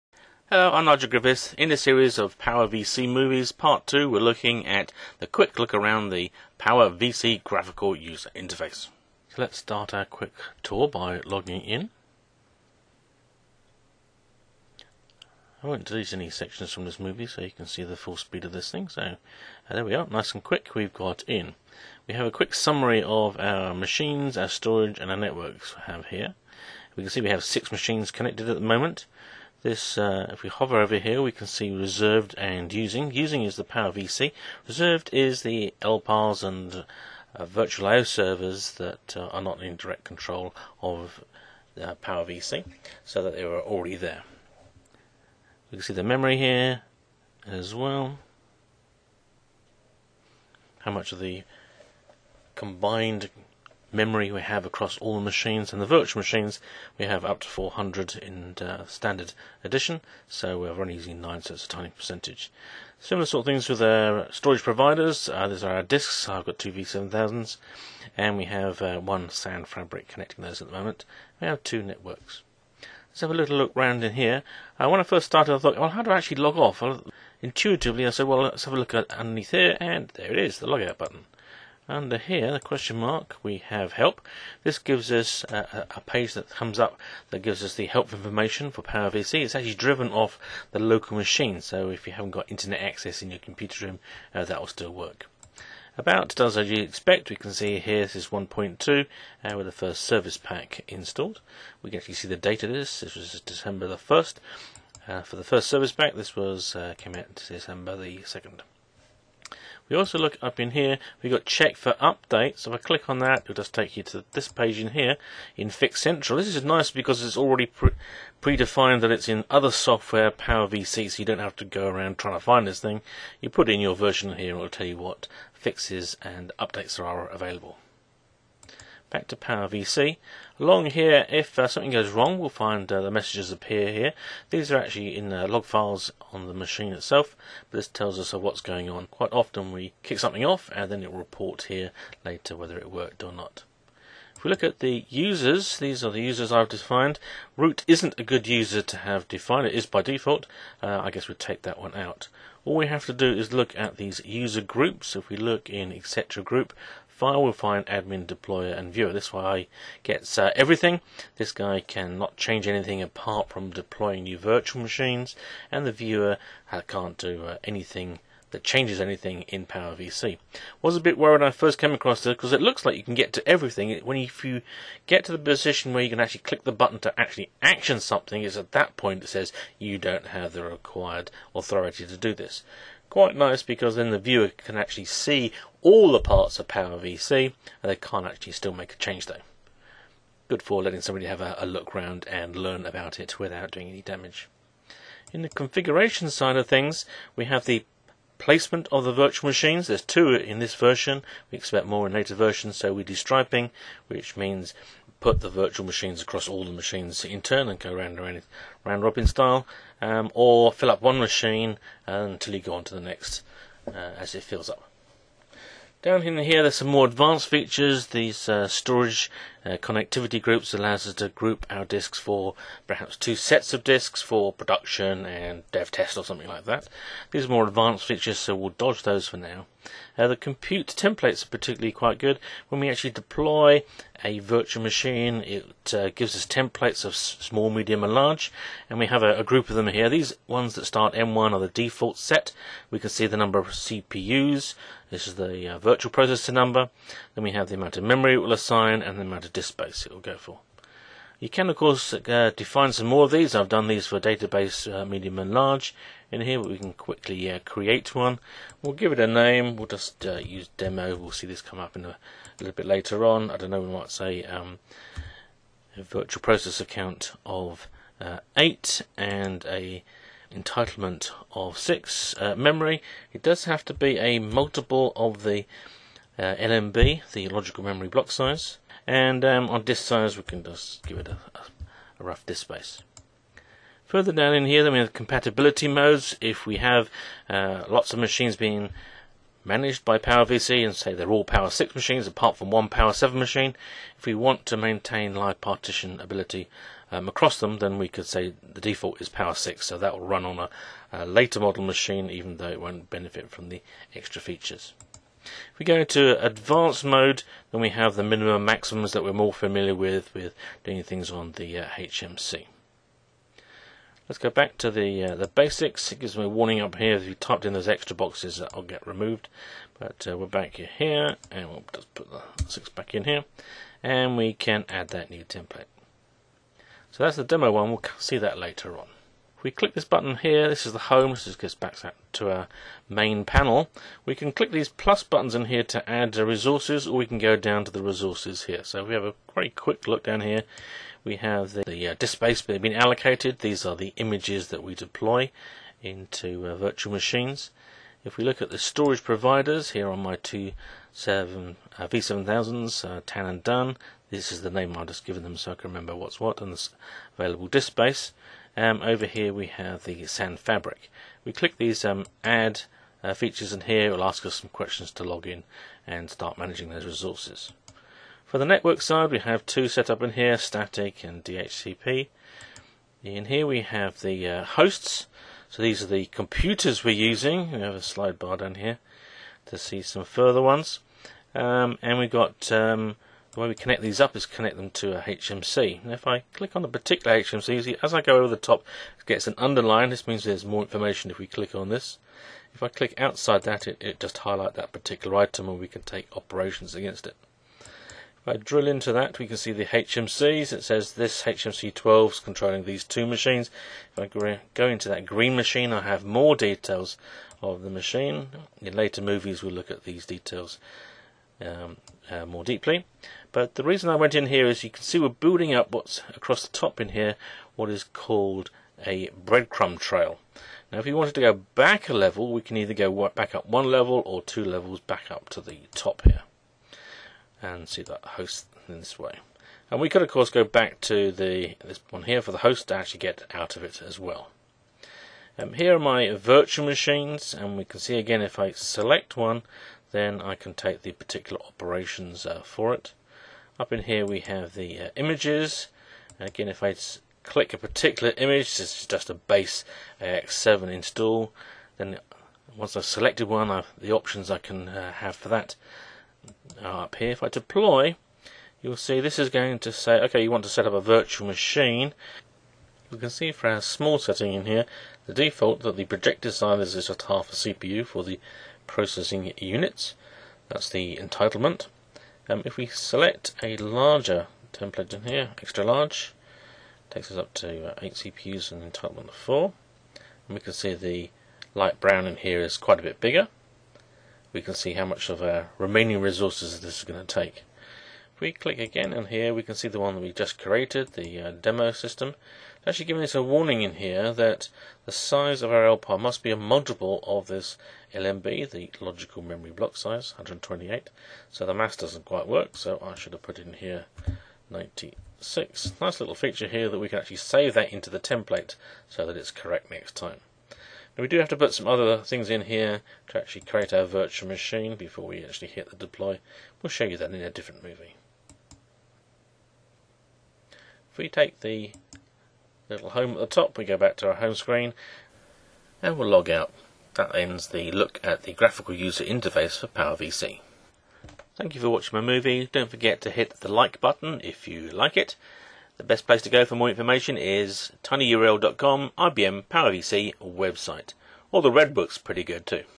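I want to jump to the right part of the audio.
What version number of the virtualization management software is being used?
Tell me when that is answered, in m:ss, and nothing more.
1:38.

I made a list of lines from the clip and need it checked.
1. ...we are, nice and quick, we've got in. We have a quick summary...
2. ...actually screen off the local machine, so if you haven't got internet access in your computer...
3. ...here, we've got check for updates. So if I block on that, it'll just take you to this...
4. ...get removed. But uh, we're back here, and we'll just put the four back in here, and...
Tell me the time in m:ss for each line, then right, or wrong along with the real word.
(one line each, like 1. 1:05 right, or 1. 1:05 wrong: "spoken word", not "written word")
1. 0:19 right
2. 1:29 wrong: "driven", not "screen"
3. 1:50 wrong: "click", not "block"
4. 5:18 wrong: "six", not "four".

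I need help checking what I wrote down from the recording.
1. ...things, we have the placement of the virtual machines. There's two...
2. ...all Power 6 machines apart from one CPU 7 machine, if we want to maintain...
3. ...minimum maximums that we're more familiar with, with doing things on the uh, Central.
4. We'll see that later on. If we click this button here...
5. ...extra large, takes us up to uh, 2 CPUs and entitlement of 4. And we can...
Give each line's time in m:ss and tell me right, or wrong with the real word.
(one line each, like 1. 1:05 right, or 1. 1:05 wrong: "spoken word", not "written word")
1. 3:16 right
2. 4:51 wrong: "Power", not "CPU"
3. 5:08 wrong: "HMC", not "Central"
4. 5:27 right
5. 7:55 wrong: "8", not "2".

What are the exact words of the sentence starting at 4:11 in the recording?
You can of course uh, define some more of these.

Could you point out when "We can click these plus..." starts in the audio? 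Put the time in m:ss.
5:34.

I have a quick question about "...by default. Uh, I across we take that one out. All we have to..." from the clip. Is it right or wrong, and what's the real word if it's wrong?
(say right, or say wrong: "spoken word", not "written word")
wrong: "guess", not "across".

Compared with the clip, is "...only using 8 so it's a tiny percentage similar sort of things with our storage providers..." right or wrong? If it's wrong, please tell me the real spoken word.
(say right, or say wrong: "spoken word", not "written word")
wrong: "9", not "8".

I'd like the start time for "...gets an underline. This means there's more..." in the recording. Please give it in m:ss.
6:29.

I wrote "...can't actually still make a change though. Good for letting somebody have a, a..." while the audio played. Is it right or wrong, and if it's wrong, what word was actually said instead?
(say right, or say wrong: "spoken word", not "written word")
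right.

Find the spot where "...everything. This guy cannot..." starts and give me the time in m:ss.
2:40.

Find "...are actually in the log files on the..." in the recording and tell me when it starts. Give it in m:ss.
2:14.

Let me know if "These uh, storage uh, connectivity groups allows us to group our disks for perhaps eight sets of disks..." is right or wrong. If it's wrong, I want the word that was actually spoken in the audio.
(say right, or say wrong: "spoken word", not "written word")
wrong: "two", not "eight".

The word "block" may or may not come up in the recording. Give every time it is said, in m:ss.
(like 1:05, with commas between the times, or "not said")
4:38, 8:19.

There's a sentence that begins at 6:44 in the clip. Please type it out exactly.
If I go into that green machine, I have more details of the machine.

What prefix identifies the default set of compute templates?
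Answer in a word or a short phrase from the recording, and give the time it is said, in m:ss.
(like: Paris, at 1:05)
M1, at 4:01.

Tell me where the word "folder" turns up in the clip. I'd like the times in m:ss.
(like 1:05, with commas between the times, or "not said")
not said.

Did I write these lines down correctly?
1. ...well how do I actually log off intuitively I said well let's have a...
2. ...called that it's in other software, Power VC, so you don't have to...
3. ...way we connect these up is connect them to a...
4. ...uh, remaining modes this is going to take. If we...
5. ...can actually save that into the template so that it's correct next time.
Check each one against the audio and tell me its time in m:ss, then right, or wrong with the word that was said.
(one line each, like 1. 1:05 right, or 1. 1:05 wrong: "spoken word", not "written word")
1. 1:15 right
2. 1:58 wrong: "predefined", not "called"
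3. 6:23 right
4. 8:05 wrong: "resources", not "modes"
5. 8:27 right.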